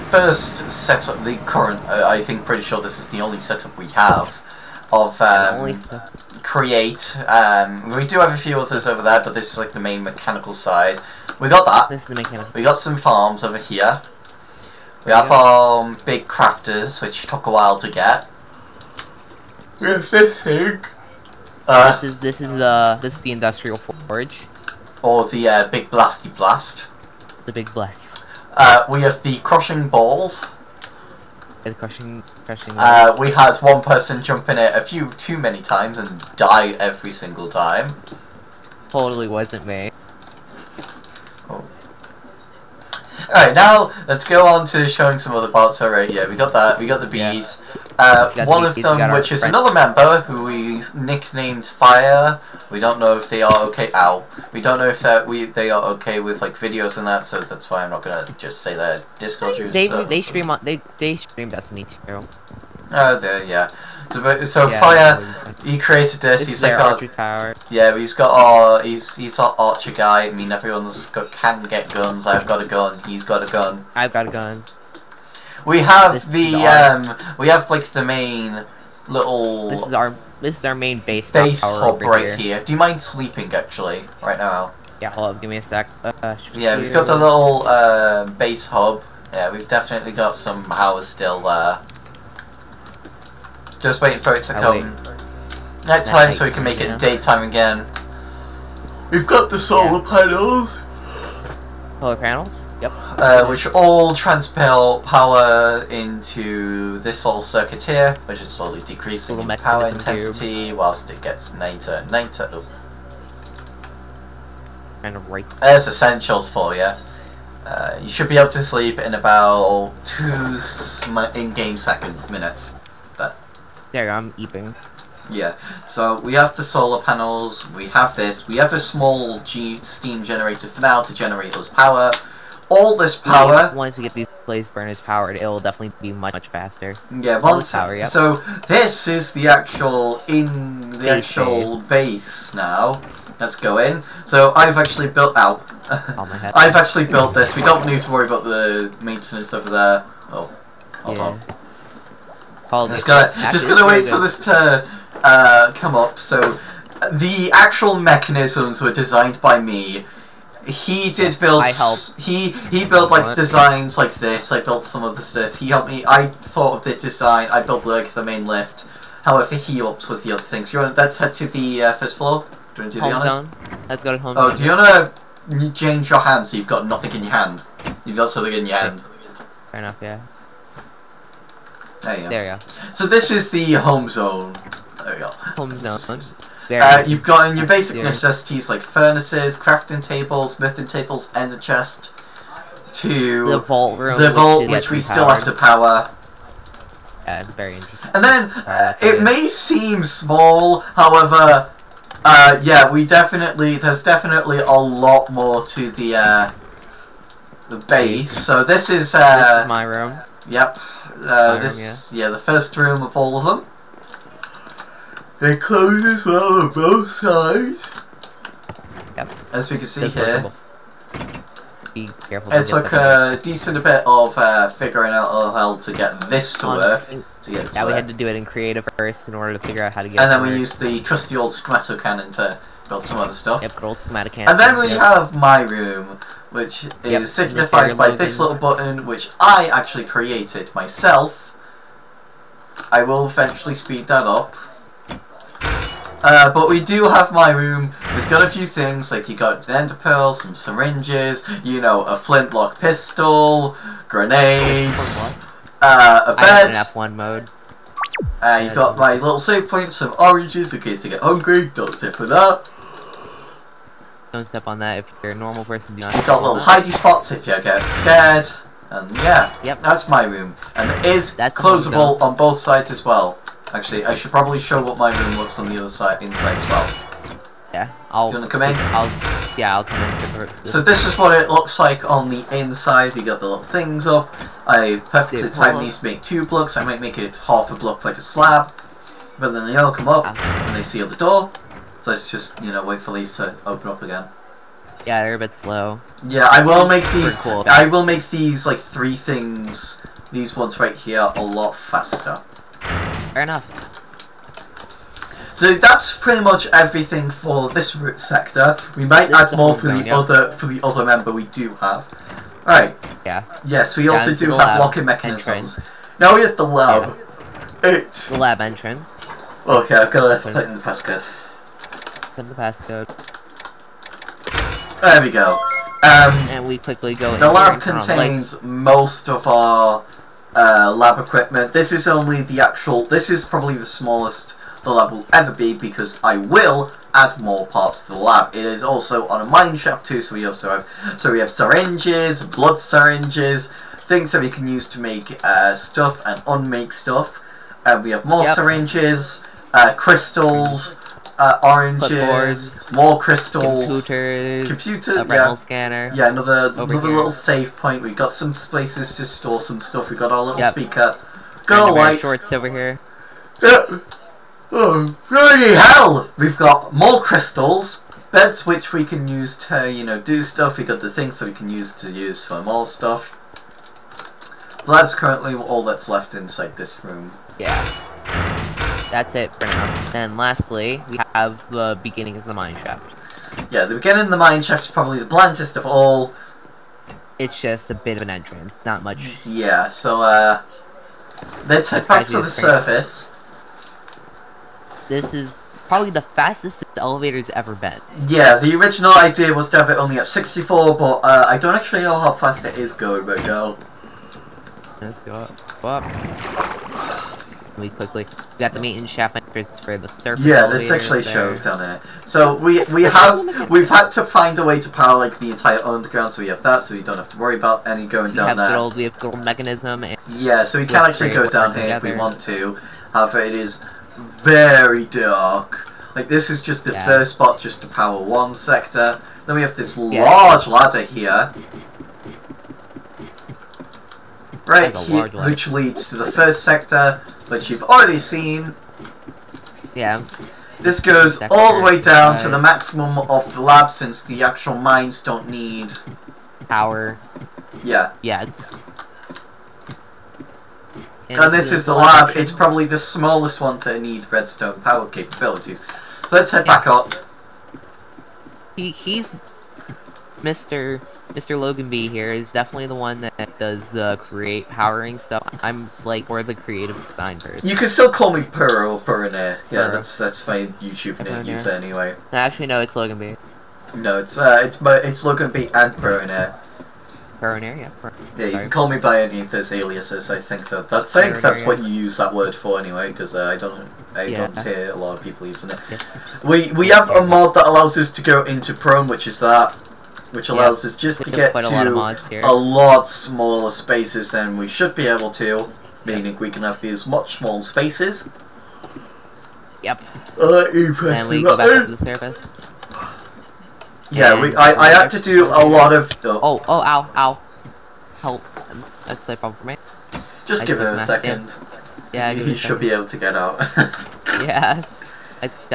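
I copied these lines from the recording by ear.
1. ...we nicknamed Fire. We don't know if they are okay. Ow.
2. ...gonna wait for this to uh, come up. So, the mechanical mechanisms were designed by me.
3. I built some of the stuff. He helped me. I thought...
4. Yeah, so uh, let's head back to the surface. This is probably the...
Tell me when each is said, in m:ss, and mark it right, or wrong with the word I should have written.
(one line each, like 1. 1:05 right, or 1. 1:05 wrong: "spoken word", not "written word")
1. 0:50 right
2. 2:33 wrong: "actual", not "mechanical"
3. 2:44 right
4. 6:29 right.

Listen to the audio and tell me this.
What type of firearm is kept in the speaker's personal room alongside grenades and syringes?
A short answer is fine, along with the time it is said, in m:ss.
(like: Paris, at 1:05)
Flintlock pistol, at 4:12.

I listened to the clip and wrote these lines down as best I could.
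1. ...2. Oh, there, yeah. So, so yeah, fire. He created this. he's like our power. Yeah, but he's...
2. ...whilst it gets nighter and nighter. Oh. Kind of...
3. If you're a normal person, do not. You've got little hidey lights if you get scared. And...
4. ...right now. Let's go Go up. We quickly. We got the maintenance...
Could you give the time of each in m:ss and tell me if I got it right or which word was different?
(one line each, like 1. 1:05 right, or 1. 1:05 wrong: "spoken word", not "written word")
1. 1:02 right
2. 1:50 right
3. 4:24 wrong: "spots", not "lights"
4. 6:43 right.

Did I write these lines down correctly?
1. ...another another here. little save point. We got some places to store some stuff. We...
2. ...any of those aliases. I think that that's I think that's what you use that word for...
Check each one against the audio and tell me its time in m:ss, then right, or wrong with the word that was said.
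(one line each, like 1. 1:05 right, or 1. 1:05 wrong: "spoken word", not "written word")
1. 5:56 right
2. 7:59 right.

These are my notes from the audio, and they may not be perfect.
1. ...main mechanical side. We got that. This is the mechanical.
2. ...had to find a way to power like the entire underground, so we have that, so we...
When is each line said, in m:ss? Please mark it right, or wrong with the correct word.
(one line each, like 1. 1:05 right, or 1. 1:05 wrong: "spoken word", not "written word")
1. 0:09 right
2. 6:53 right.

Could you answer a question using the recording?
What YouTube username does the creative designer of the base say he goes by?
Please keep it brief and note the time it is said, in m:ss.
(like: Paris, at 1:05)
Pearl Perner, at 7:48.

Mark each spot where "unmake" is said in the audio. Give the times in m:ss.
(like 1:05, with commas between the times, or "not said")
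5:46.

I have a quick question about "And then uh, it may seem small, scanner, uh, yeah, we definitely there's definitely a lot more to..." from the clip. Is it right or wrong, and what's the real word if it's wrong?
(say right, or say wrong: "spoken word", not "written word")
wrong: "however", not "scanner".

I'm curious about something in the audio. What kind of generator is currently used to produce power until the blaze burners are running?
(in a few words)
Steam generator.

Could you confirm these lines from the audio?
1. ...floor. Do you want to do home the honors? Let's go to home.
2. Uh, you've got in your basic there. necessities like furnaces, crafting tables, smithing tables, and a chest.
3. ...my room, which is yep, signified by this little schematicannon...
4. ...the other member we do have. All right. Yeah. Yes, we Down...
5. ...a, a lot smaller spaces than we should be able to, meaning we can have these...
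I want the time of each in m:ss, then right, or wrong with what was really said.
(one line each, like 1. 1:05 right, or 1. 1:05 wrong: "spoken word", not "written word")
1. 2:52 right
2. 3:06 right
3. 3:55 wrong: "button", not "schematicannon"
4. 5:10 right
5. 8:11 right.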